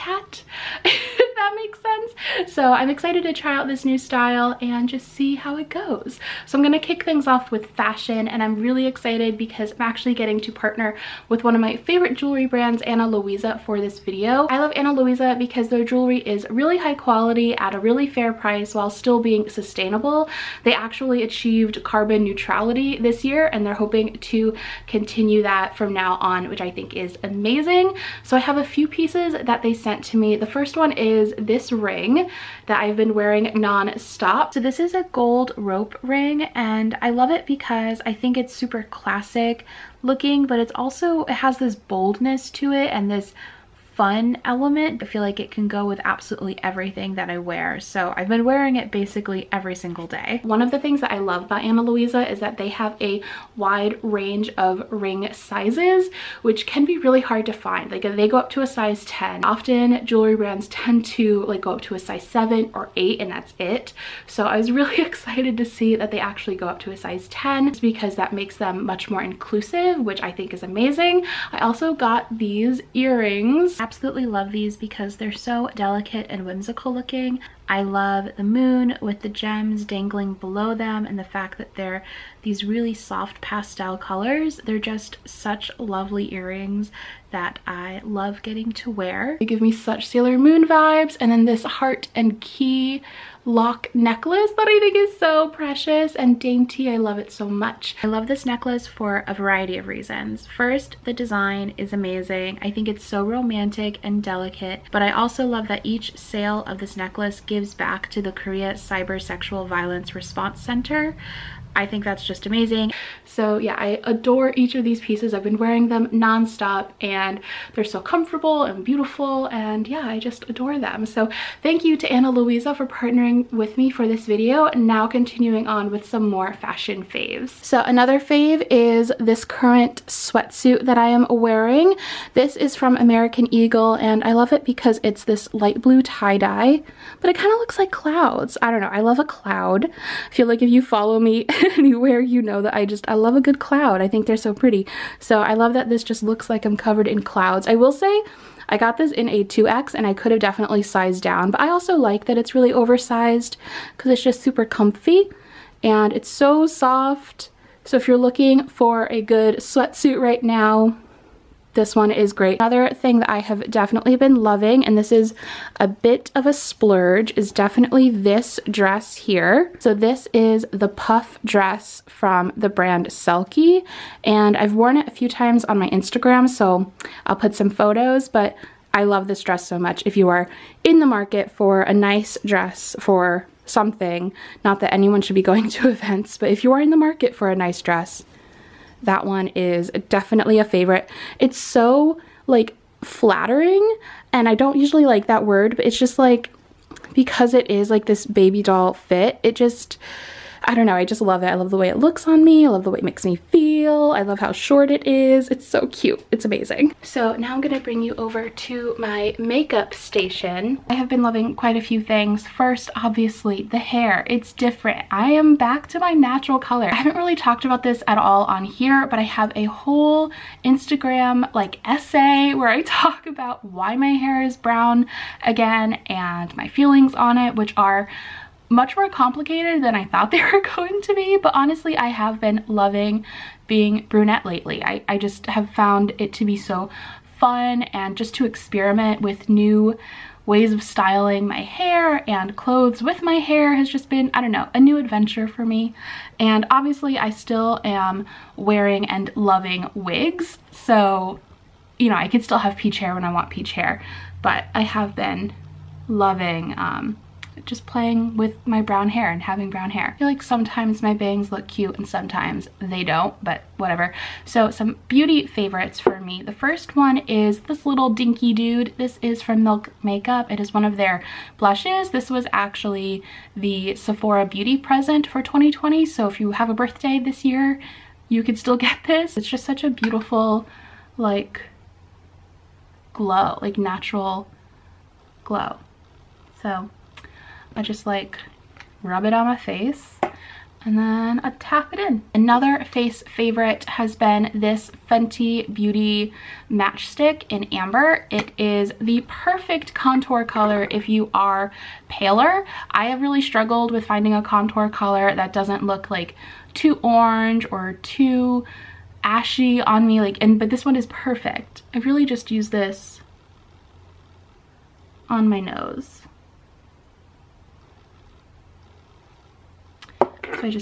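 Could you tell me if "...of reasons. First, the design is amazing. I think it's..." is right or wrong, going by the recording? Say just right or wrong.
right.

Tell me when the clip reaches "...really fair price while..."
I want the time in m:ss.
0:17.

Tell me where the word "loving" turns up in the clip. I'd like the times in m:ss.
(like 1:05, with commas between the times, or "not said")
2:44, 3:31, 3:52, 4:09, 4:16.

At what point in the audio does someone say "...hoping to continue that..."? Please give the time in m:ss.
0:23.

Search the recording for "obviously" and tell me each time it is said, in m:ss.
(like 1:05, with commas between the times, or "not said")
3:32, 4:06.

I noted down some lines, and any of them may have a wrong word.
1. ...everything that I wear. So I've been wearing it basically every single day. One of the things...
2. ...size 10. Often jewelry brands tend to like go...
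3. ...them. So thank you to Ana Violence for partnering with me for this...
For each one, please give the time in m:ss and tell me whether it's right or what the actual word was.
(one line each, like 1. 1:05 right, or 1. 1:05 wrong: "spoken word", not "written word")
1. 0:46 right
2. 0:58 right
3. 2:00 wrong: "Luisa", not "Violence".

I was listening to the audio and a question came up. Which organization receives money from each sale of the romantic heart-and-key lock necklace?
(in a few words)
Korea Cyber Sexual Violence Response Center.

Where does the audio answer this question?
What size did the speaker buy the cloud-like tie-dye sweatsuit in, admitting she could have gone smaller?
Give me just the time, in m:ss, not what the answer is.
2:29.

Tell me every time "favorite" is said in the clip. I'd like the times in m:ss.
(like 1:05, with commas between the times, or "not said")
0:11, 3:10, 4:25, 4:53.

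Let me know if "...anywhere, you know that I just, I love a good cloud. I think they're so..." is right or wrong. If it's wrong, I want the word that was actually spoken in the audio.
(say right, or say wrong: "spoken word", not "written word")
right.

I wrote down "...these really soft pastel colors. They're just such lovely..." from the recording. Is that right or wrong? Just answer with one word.
right.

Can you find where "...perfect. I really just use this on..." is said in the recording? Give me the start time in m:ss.
5:11.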